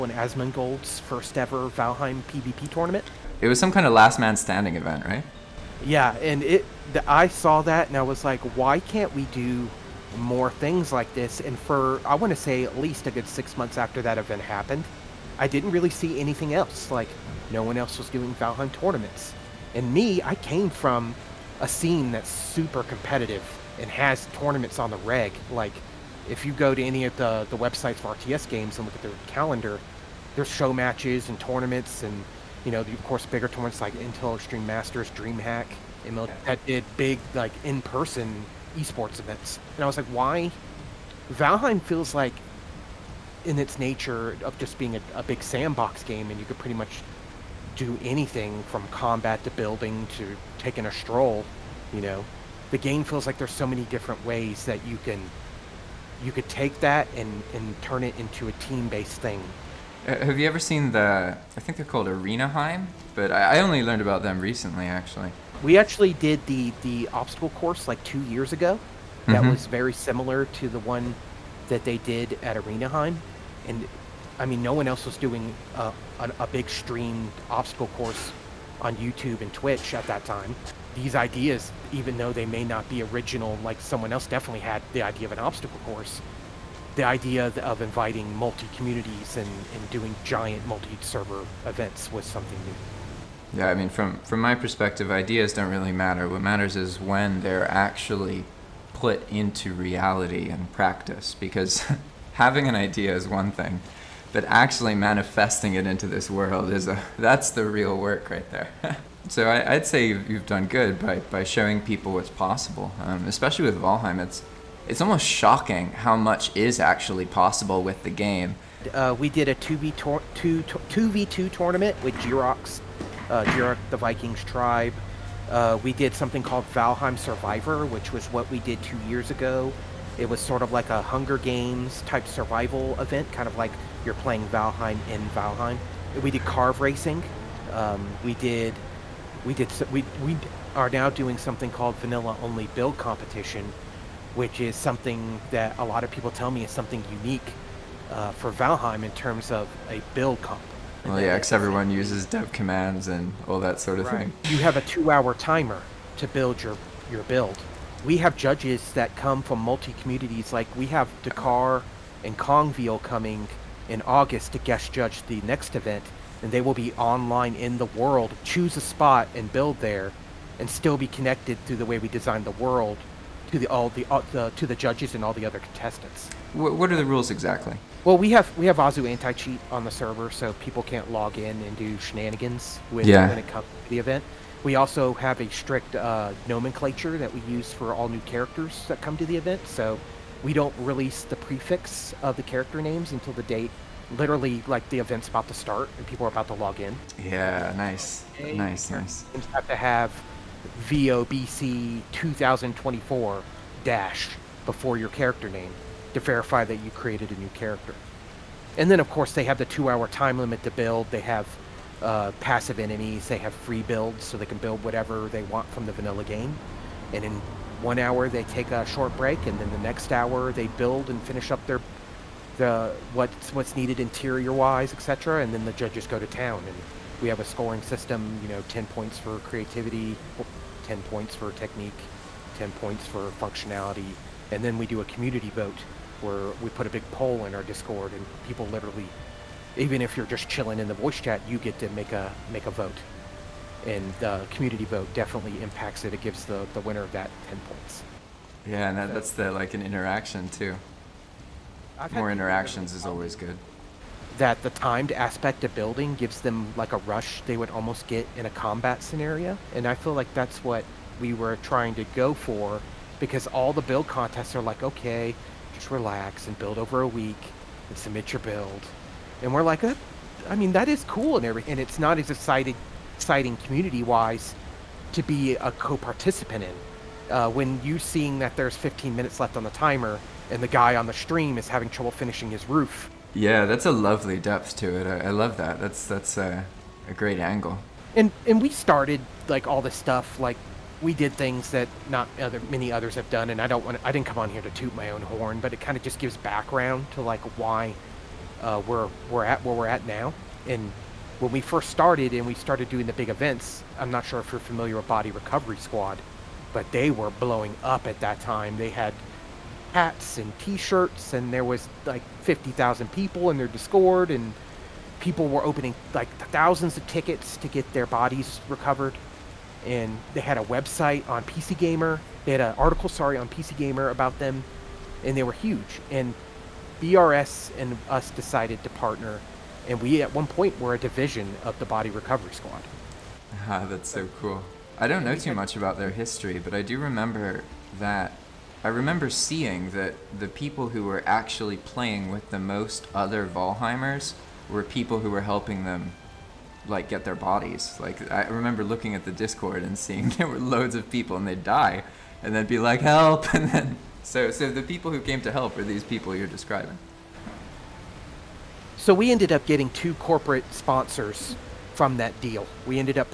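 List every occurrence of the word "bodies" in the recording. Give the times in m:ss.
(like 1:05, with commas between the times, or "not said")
5:18, 5:47.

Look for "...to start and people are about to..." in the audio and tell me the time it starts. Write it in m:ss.
3:15.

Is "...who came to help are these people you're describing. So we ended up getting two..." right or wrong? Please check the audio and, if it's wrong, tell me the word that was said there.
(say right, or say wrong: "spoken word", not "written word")
right.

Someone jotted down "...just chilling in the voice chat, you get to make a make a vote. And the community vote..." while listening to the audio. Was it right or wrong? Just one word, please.
right.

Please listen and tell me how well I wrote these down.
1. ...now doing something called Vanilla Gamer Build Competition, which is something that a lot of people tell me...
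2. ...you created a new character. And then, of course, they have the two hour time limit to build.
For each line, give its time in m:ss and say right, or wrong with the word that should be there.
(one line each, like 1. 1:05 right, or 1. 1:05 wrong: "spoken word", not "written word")
1. 2:20 wrong: "Only", not "Gamer"
2. 3:26 right.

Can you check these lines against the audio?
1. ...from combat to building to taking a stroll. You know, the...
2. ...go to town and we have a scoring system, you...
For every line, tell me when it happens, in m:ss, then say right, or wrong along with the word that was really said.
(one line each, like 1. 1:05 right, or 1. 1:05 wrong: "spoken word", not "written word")
1. 0:48 right
2. 3:46 right.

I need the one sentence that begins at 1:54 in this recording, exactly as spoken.
It's, it's almost shocking how much is actually possible with the game.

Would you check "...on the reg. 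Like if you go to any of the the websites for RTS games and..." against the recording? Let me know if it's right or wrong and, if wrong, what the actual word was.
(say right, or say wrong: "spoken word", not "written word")
right.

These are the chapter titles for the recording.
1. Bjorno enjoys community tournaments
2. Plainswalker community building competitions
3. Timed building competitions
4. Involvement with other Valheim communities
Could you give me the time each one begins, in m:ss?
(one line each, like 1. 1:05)
1. 1:59
2. 2:33
3. 4:15
4. 5:05.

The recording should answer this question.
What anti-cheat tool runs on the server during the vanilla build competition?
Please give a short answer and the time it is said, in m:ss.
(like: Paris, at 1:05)
Azu anti cheat, at 2:58.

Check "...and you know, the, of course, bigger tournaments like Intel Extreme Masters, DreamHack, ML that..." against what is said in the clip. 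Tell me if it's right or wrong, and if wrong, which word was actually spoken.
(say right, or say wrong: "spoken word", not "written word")
right.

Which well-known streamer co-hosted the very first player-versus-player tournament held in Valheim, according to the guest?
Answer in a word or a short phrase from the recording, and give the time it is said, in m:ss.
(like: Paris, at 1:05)
Asmongold, at 0:00.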